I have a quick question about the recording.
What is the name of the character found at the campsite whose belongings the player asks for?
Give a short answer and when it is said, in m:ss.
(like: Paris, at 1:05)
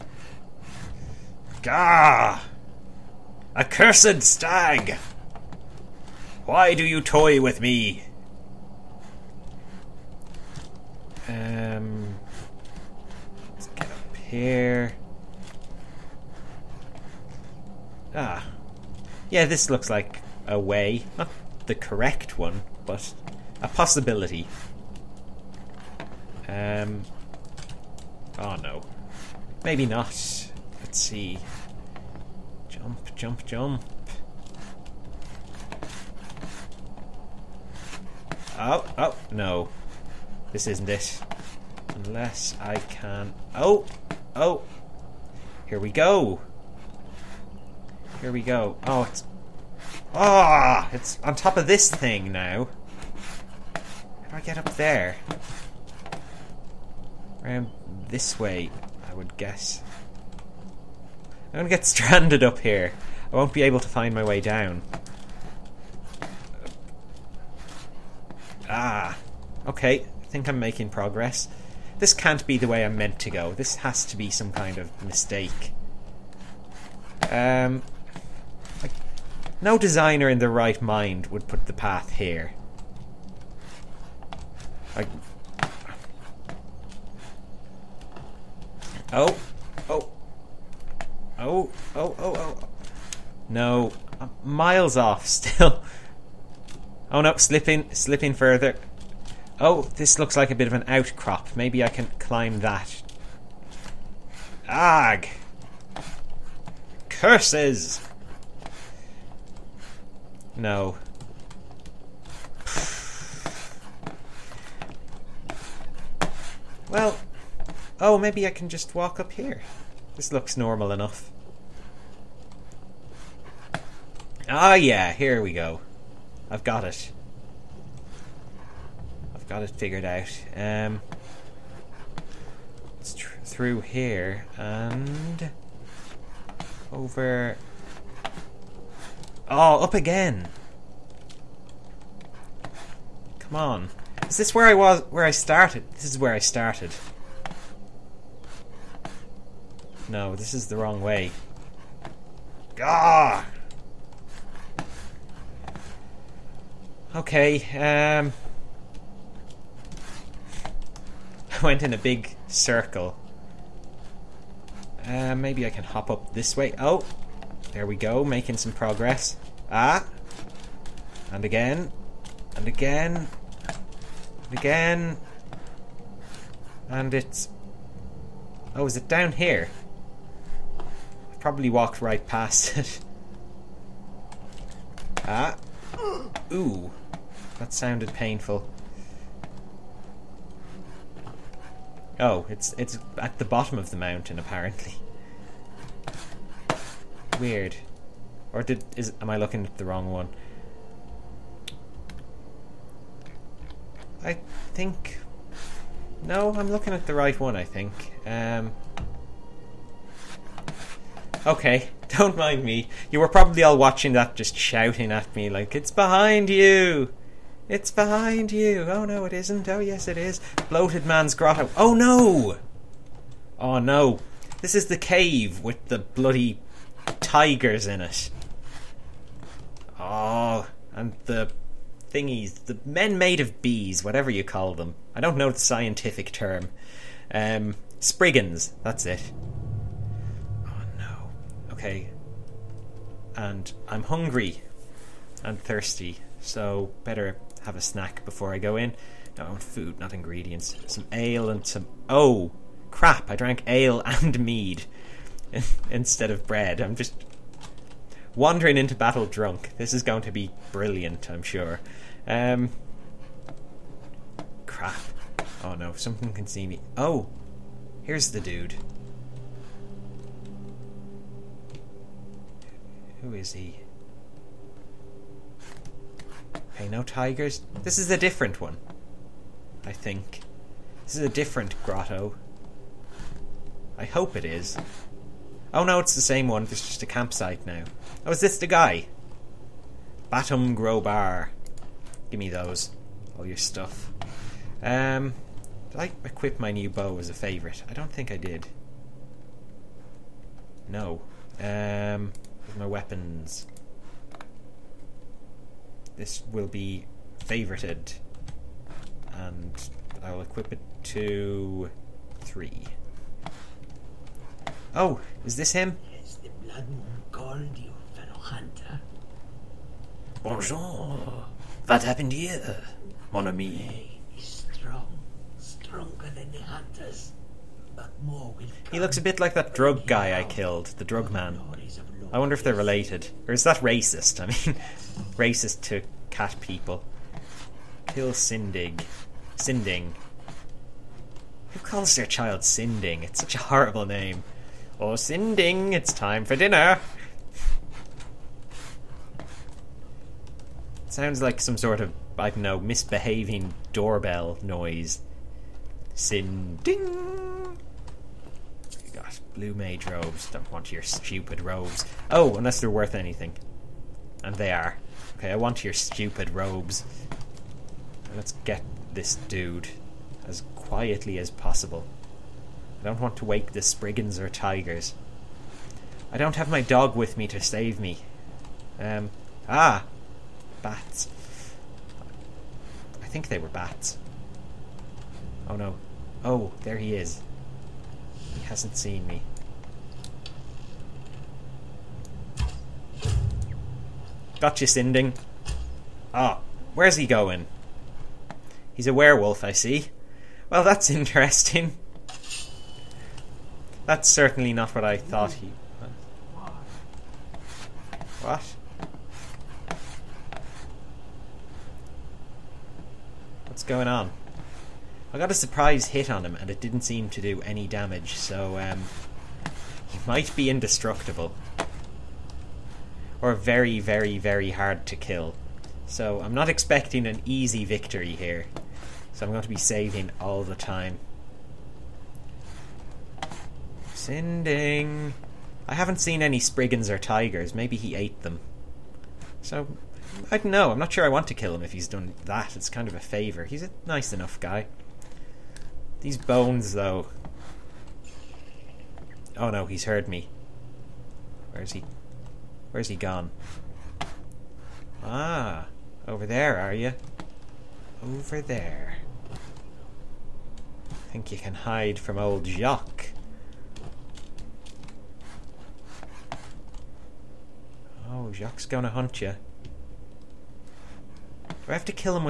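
Batum gra-Bar, at 4:50.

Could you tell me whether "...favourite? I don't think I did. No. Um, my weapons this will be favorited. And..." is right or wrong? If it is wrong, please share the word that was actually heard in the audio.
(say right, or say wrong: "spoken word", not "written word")
right.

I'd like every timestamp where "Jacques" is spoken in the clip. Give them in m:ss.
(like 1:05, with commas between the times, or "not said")
7:42, 7:48.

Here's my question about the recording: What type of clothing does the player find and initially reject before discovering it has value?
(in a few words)
Blue mage robes.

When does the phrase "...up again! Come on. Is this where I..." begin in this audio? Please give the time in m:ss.
2:19.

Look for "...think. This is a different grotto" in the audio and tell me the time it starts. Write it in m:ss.
4:39.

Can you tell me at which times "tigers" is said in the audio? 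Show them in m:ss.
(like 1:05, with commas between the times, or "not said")
3:47, 4:37, 6:14, 7:17.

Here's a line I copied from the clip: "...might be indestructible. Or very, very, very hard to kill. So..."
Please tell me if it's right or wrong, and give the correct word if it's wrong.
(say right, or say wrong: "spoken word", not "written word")
right.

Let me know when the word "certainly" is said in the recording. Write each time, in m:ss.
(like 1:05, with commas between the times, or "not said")
6:44.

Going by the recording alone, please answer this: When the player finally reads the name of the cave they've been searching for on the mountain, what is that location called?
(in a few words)
Bloated Man's Grotto.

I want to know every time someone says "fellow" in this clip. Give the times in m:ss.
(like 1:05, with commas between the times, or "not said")
5:18.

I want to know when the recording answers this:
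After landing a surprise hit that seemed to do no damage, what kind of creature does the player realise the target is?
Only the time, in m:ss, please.
6:39.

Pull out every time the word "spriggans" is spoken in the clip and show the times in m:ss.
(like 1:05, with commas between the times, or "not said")
3:57, 6:13, 7:16.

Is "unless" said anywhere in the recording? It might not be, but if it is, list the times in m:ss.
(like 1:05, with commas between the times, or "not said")
0:41, 6:02.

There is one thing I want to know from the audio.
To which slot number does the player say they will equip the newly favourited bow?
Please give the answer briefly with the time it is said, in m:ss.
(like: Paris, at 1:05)
3, at 5:12.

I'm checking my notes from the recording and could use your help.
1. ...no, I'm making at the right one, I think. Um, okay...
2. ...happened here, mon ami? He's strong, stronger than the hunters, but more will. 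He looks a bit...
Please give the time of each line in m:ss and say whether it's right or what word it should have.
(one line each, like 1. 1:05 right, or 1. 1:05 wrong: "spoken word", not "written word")
1. 3:26 wrong: "looking", not "making"
2. 5:22 right.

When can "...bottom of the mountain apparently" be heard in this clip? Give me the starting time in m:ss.
3:13.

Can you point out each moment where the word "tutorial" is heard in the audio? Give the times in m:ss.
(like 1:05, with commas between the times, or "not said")
not said.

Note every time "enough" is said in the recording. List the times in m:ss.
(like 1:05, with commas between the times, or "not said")
2:00, 7:24.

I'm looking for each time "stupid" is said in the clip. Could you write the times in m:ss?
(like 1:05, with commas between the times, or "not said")
6:01, 6:05.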